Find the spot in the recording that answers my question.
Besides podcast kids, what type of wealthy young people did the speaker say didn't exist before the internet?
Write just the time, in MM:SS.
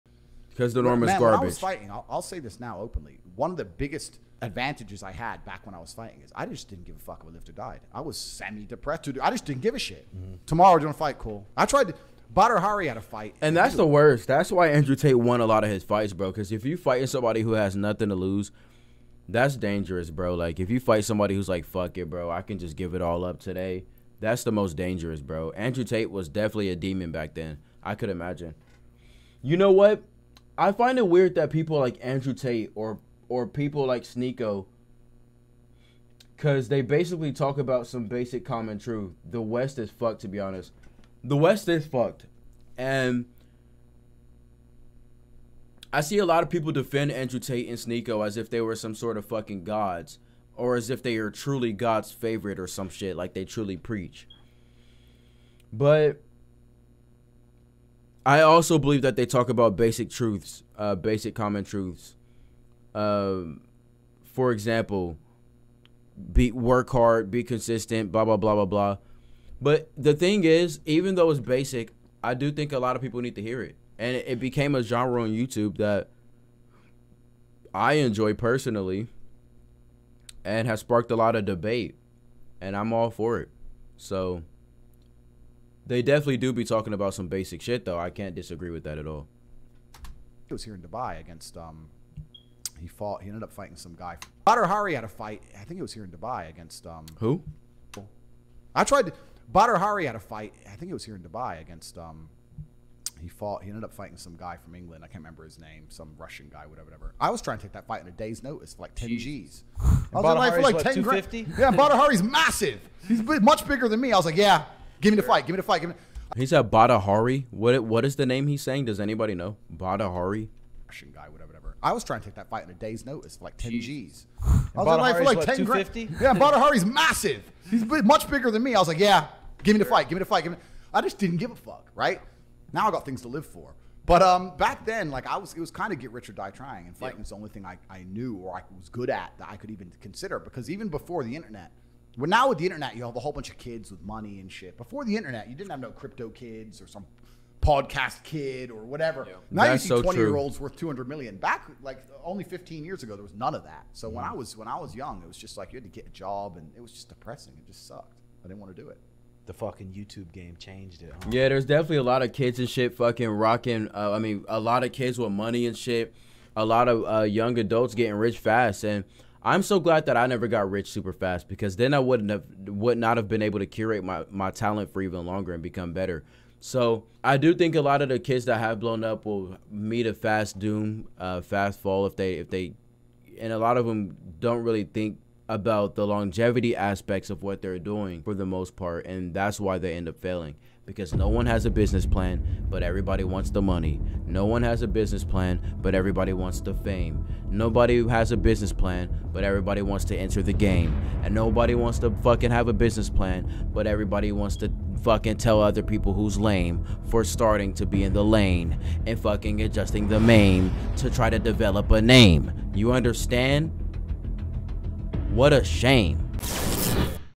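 02:25.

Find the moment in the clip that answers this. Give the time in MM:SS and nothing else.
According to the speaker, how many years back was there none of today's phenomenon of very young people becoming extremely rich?
02:32.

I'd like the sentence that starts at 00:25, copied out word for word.
Andrew Tate was definitely a demon back then.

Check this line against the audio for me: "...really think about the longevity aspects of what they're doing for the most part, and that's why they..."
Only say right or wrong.
right.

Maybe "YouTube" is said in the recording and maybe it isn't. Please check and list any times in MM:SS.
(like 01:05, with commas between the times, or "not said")
01:15, 02:39.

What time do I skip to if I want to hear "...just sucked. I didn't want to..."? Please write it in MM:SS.
02:37.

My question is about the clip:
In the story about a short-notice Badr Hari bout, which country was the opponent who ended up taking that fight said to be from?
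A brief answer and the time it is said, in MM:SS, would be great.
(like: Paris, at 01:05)
England, at 01:44.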